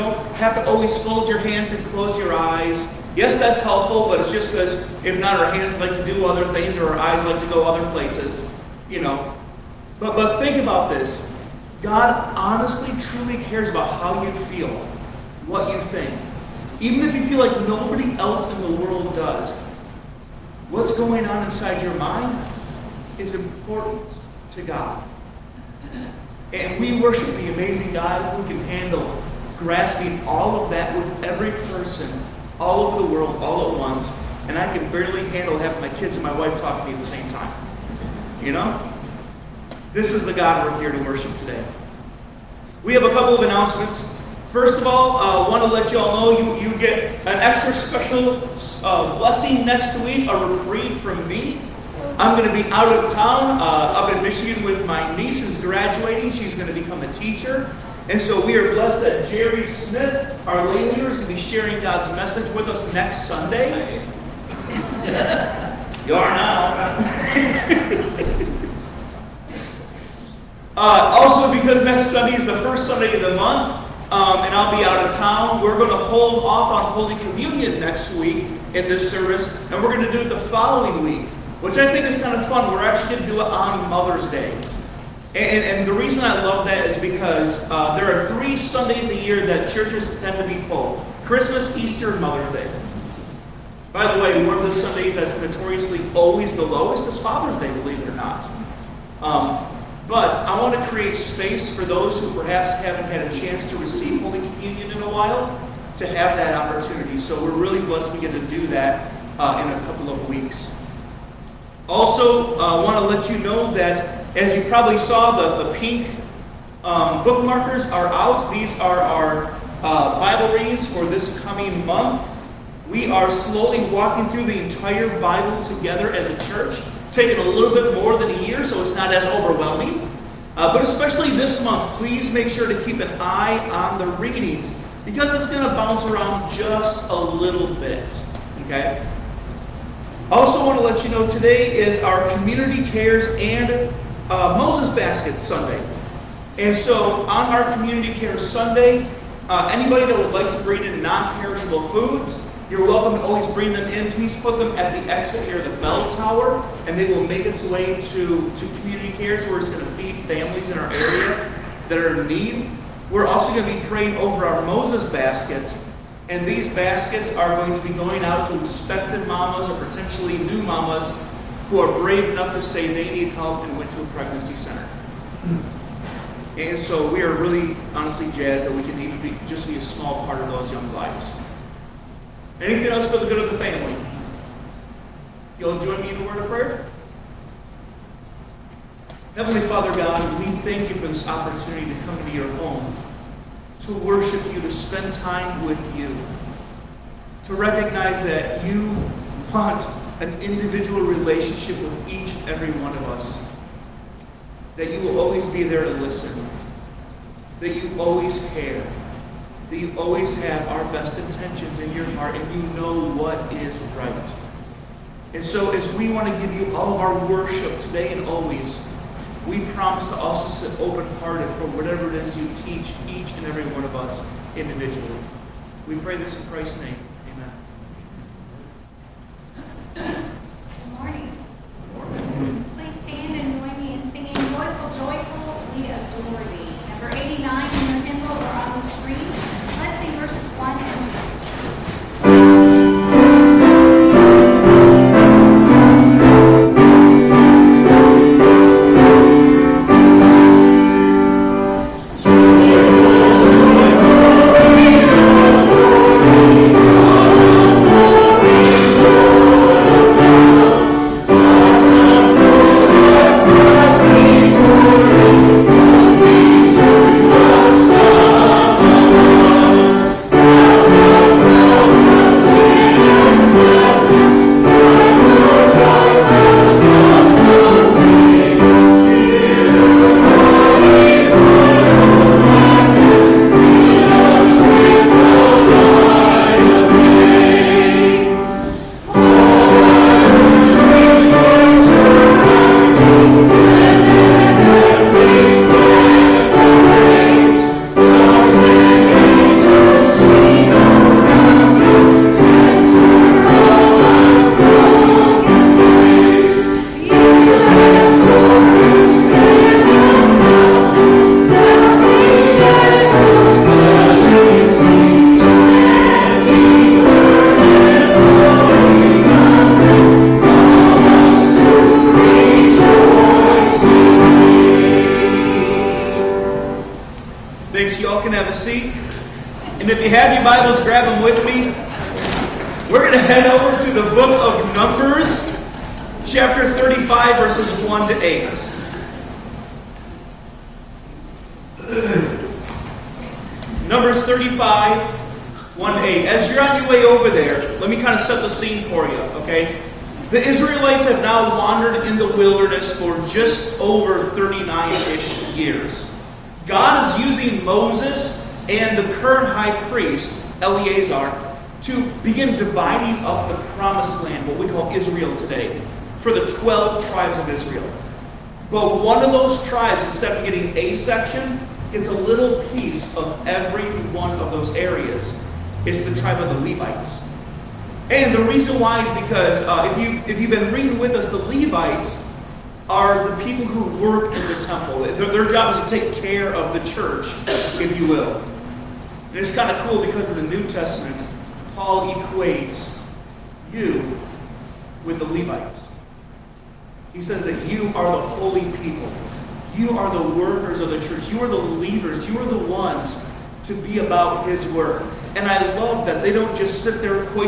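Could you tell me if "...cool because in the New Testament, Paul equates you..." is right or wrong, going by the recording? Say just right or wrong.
right.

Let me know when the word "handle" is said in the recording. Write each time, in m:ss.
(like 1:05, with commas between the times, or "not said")
0:28, 0:35.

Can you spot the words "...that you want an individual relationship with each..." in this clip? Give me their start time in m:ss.
3:18.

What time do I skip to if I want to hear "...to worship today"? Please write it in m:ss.
0:40.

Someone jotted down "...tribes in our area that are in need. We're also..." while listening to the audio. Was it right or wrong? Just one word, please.
wrong.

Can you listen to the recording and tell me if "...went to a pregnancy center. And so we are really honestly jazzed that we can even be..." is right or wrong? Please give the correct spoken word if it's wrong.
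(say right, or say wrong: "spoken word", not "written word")
right.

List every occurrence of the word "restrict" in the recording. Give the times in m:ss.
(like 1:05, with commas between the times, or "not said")
not said.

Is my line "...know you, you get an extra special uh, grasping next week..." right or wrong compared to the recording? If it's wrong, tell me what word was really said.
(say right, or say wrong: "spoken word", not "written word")
wrong: "blessing", not "grasping".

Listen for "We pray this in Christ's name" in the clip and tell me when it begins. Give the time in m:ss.
3:45.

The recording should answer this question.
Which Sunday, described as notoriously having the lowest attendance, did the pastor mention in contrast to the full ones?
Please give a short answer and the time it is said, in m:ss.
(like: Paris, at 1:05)
Father's Day, at 1:37.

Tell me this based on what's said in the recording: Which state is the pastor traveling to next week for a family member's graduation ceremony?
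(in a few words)
Michigan.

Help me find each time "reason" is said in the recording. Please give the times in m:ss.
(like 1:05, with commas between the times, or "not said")
1:25, 6:18.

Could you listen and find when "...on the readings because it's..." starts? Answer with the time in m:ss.
2:13.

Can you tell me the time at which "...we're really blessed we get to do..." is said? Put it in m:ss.
1:47.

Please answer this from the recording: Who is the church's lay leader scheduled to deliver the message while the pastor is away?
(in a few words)
Jerry Smith.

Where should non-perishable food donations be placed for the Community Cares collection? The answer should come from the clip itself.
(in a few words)
Exit near the bell tower.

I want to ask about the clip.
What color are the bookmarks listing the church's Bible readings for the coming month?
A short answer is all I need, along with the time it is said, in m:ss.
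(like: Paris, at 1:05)
Pink, at 1:55.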